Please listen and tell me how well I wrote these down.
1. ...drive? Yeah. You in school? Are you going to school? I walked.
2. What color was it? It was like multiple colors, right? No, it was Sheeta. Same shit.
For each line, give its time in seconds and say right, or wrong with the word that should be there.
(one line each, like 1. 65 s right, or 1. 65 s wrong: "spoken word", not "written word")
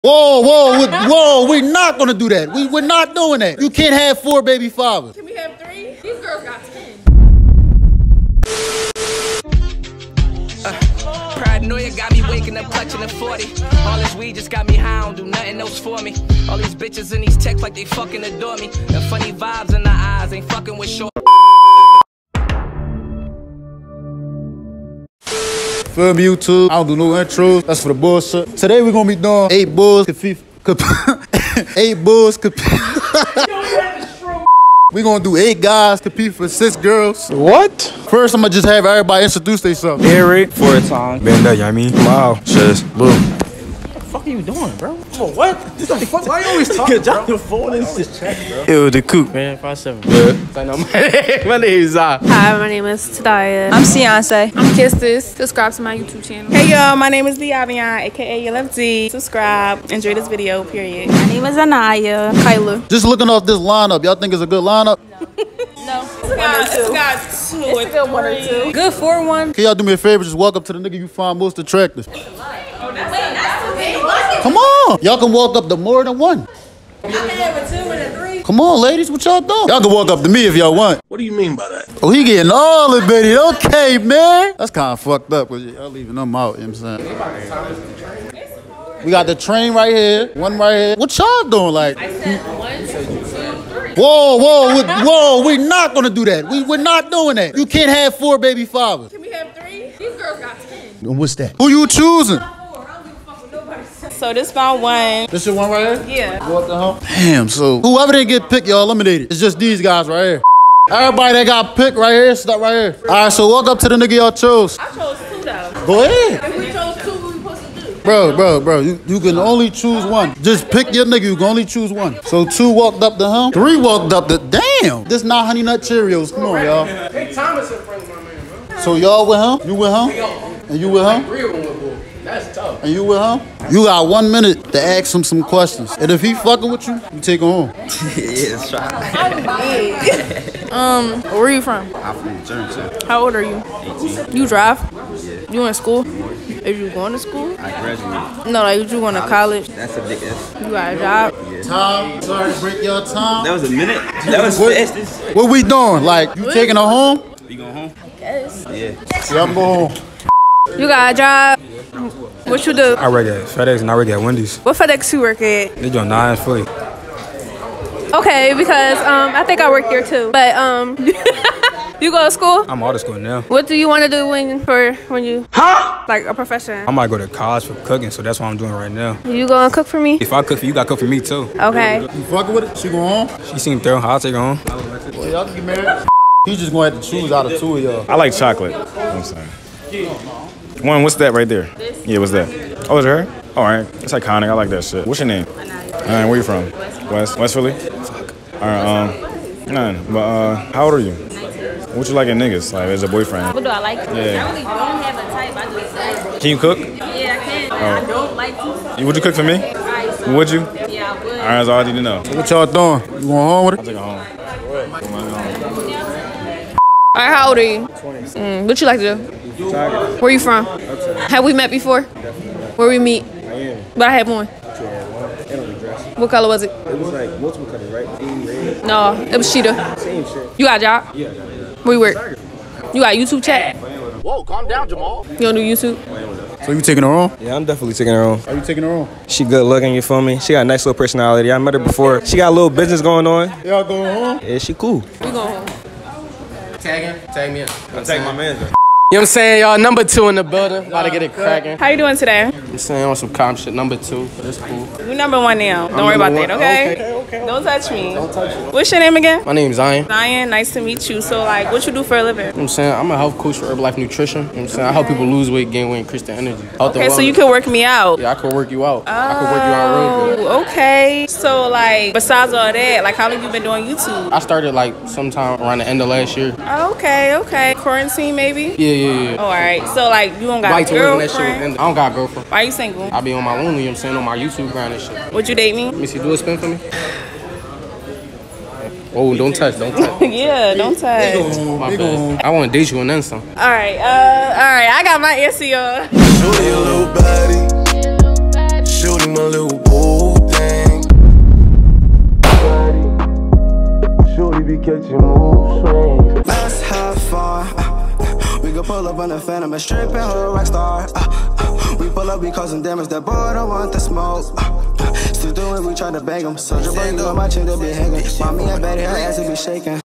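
1. 144 s wrong: "graduated", not "walked"
2. 226 s right.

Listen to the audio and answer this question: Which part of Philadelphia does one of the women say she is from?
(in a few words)
West Philly.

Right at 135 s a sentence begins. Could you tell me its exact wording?
And if he fucking with you, you take him home.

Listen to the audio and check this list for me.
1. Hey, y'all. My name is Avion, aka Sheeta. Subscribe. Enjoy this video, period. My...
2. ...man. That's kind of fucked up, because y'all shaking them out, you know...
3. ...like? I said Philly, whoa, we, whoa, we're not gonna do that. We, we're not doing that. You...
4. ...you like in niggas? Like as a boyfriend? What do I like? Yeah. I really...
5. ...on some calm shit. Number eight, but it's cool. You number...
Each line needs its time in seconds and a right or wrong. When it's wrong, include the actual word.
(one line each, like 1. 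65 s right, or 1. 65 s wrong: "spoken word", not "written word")
1. 56 s wrong: "LFD", not "Sheeta"
2. 83 s wrong: "leaving", not "shaking"
3. 91 s wrong: "Whoa", not "Philly"
4. 202 s right
5. 253 s wrong: "two", not "eight".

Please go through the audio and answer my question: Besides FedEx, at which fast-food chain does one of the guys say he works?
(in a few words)
Wendy's.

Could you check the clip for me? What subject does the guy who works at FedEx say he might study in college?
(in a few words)
Cooking.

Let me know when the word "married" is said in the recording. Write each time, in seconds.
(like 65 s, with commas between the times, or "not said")
185 s.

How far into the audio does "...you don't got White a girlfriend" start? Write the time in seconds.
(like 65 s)
280 s.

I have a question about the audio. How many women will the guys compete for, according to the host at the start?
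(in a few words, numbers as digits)
6.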